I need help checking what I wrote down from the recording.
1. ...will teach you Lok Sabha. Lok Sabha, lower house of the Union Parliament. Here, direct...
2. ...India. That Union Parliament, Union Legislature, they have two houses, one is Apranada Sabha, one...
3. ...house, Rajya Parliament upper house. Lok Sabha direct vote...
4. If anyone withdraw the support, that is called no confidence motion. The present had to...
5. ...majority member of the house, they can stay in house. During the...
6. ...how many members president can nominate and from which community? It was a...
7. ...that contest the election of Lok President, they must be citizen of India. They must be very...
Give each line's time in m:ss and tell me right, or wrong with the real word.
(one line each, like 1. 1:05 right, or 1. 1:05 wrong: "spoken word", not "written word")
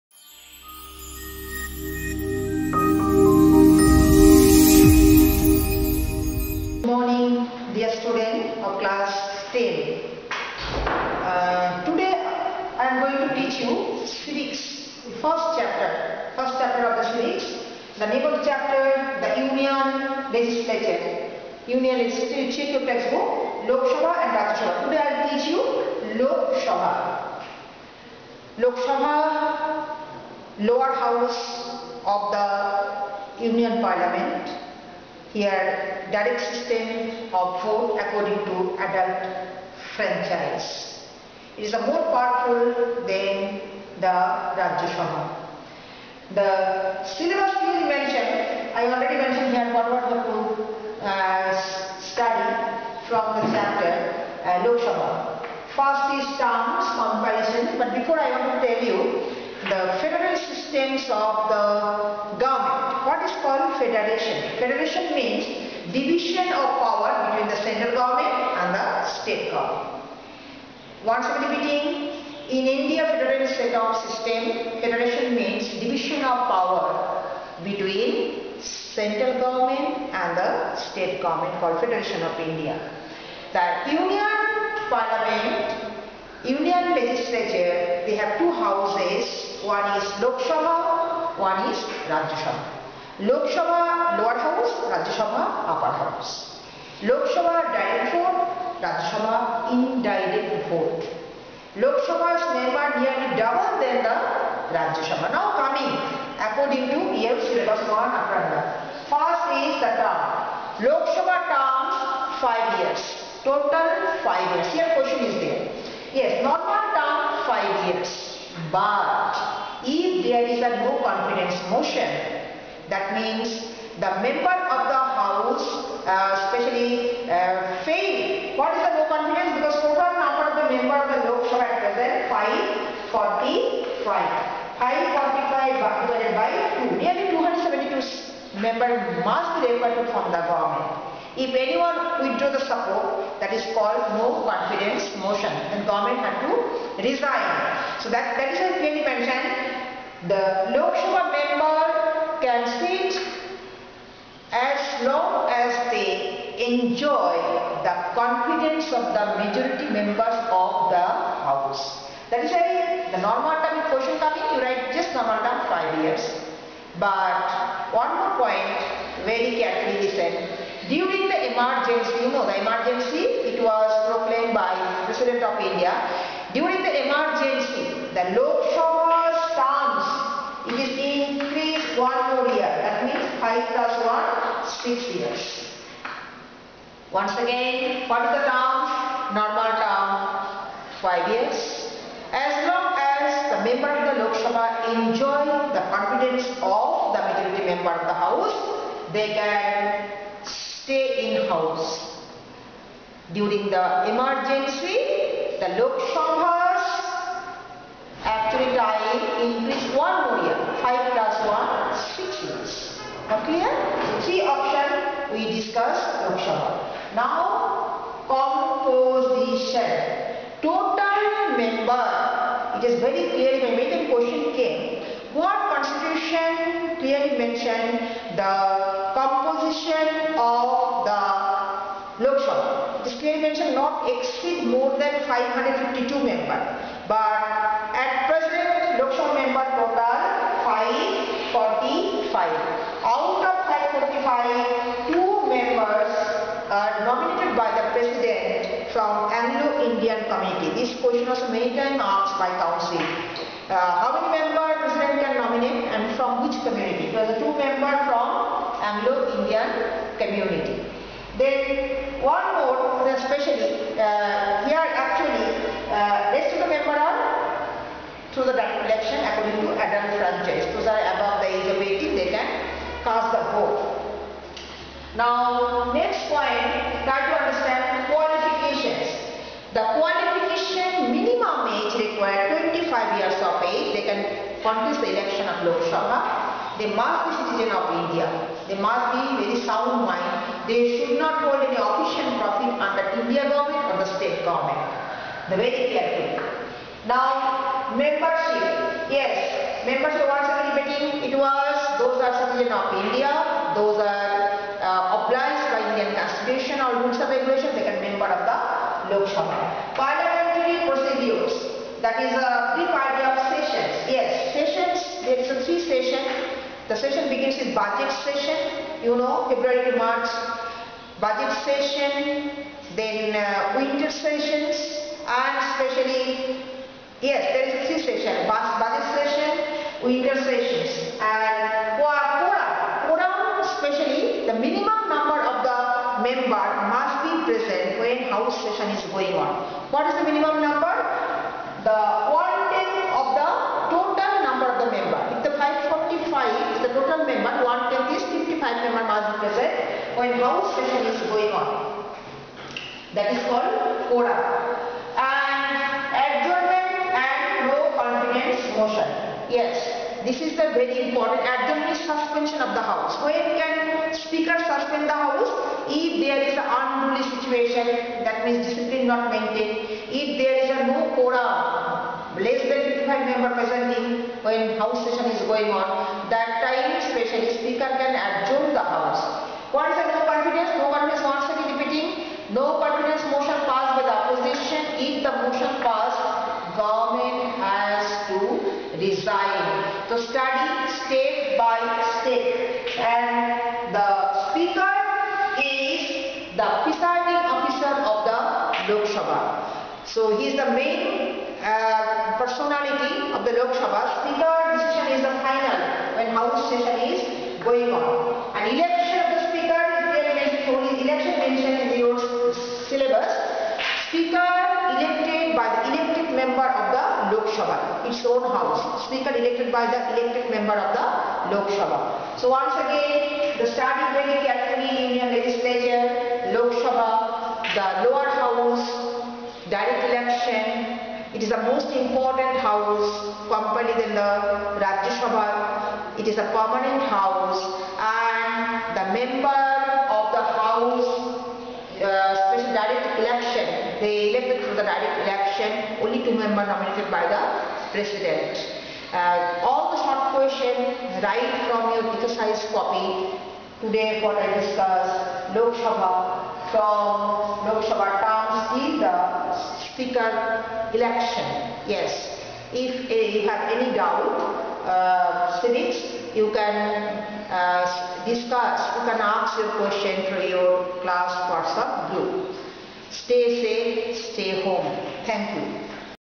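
1. 0:25 right
2. 1:22 wrong: "Lok", not "Apranada"
3. 1:34 wrong: "Sabha", not "Parliament"
4. 2:21 wrong: "government", not "present"
5. 3:17 right
6. 4:14 right
7. 4:37 wrong: "Sabha", not "President".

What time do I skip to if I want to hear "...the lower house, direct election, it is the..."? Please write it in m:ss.
7:07.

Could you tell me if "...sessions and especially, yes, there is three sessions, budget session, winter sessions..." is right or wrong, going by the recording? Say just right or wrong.
right.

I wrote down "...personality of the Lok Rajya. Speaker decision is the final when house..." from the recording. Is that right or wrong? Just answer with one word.
wrong.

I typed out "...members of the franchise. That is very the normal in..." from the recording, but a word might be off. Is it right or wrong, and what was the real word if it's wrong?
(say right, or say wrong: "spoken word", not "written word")
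wrong: "house", not "franchise".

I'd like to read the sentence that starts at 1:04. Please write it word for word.
Federation means division of power between the central government and the state government.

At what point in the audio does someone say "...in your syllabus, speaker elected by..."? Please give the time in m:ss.
6:51.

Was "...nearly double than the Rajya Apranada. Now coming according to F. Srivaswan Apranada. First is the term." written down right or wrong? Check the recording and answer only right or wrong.
wrong.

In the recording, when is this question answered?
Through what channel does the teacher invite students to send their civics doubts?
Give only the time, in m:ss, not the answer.
7:51.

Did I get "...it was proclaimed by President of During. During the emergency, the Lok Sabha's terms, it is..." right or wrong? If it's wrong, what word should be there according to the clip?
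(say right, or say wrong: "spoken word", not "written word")
wrong: "India", not "During".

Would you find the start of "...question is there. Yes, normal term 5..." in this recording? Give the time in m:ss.
1:54.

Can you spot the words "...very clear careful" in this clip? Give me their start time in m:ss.
4:55.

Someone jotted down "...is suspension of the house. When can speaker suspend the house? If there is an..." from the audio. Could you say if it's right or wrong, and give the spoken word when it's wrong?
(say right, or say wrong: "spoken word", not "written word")
right.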